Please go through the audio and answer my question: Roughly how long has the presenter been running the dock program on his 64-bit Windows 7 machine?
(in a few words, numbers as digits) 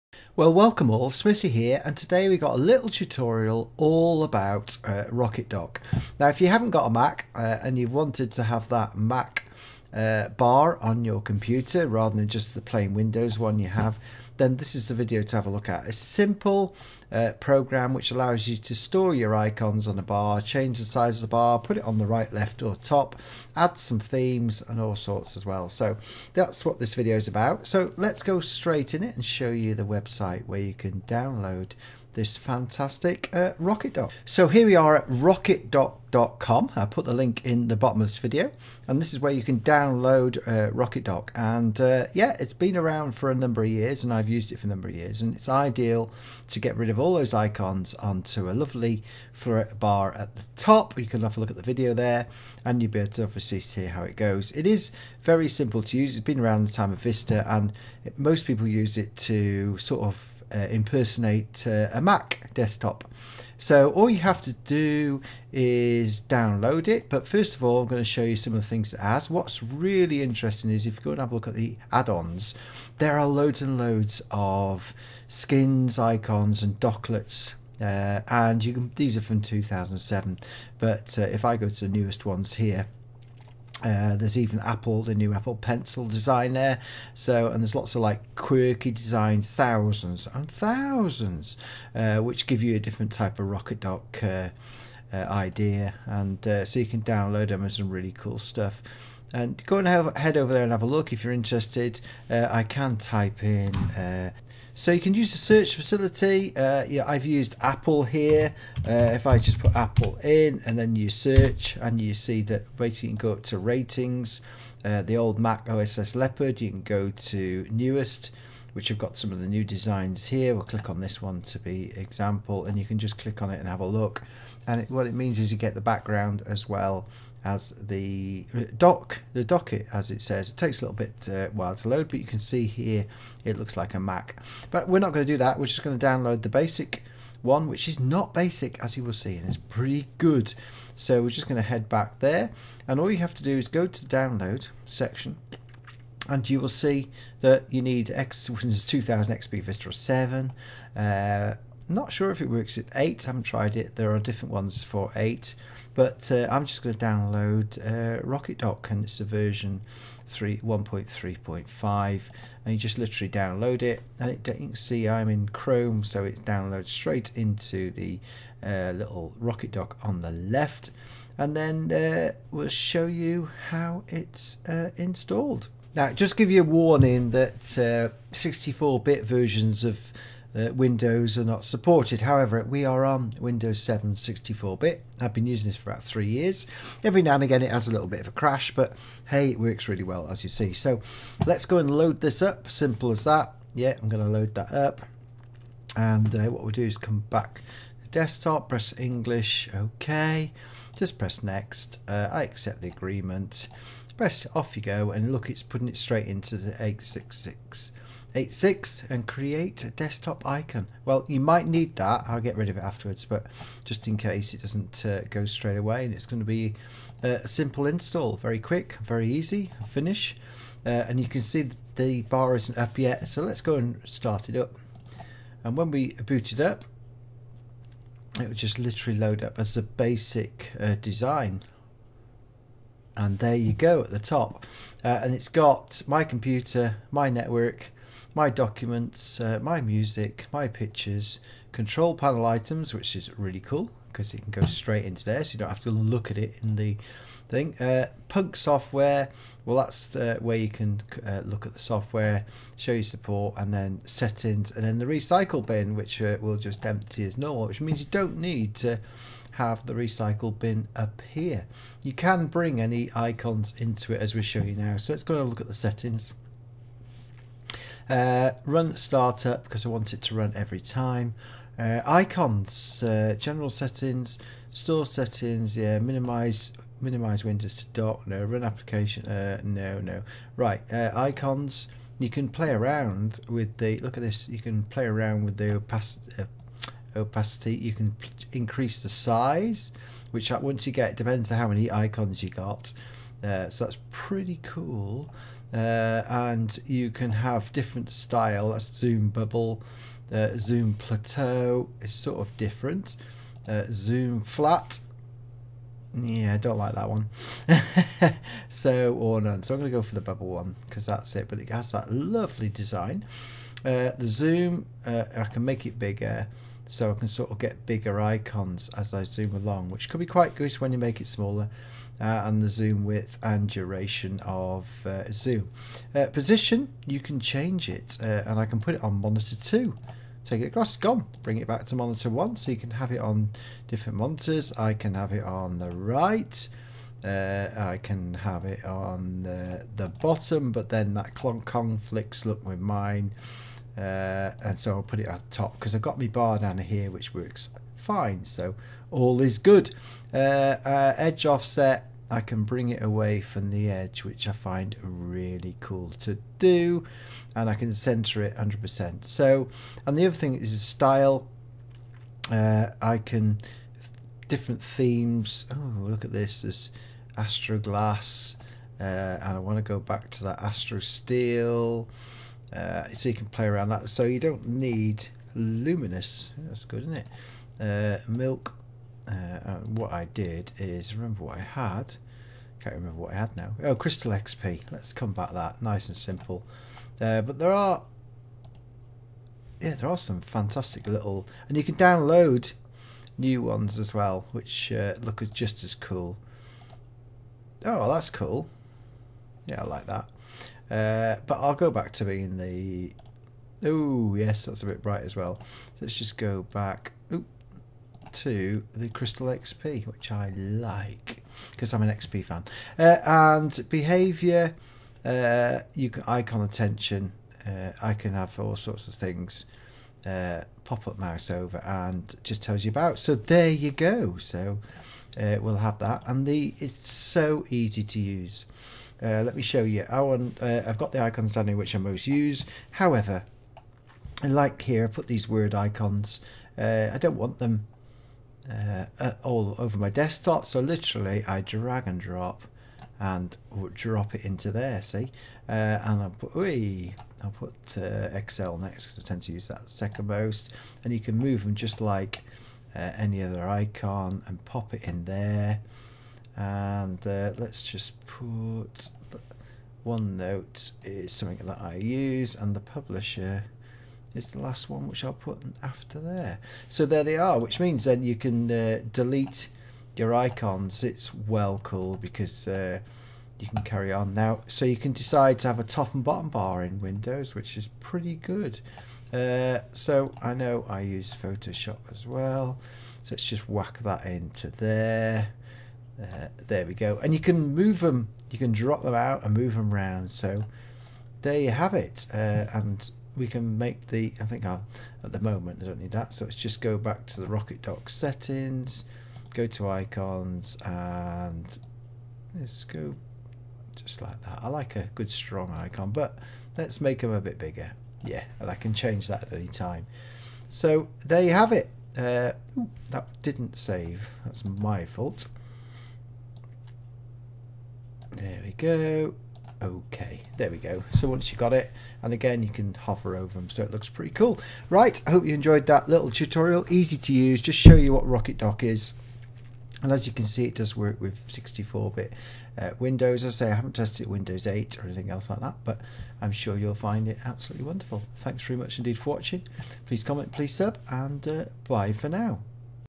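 about three years.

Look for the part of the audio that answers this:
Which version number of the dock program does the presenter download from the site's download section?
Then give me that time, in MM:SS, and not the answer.
02:40.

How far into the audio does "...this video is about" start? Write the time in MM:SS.
00:26.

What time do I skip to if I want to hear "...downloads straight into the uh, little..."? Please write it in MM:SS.
02:46.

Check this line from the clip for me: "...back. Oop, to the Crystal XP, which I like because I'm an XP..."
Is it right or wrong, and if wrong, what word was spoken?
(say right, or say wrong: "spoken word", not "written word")
right.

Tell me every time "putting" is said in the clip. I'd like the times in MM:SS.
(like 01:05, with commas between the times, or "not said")
03:25.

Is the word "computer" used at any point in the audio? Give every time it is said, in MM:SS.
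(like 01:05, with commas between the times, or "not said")
00:11, 03:56.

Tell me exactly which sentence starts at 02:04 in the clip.
And it, what it means is you get the background as well as the uh, dock, the docklet as it says.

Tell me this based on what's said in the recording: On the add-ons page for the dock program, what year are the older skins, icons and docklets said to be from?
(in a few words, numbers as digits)
2007.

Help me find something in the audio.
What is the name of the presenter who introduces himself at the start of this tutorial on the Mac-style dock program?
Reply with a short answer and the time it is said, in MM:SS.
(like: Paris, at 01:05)
Smithy, at 00:01.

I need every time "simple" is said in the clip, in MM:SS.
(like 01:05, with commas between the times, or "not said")
00:15, 00:55, 03:12, 03:37, 06:26.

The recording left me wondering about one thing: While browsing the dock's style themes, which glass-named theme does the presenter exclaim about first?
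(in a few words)
astro glass.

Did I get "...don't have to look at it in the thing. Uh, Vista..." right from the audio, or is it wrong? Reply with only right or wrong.
wrong.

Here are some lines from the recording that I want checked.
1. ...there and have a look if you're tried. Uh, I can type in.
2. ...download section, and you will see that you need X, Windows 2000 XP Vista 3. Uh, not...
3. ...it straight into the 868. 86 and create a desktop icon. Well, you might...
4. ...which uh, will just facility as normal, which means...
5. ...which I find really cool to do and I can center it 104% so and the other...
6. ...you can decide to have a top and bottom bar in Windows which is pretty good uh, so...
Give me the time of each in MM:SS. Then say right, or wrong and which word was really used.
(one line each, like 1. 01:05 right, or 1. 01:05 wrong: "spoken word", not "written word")
1. 01:40 wrong: "interested", not "tried"
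2. 02:24 wrong: "7", not "3"
3. 03:25 wrong: "866", not "868"
4. 04:15 wrong: "empty", not "facility"
5. 05:54 wrong: "100", not "104"
6. 07:54 right.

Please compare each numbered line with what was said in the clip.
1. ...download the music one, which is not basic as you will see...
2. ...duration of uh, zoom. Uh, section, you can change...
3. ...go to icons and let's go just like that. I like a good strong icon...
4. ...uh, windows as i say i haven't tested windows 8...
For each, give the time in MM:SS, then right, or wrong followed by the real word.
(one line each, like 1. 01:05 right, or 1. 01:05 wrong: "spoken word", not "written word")
1. 02:16 wrong: "basic", not "music"
2. 05:23 wrong: "position", not "section"
3. 08:19 right
4. 08:52 right.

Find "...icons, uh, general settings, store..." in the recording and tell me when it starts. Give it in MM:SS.
04:32.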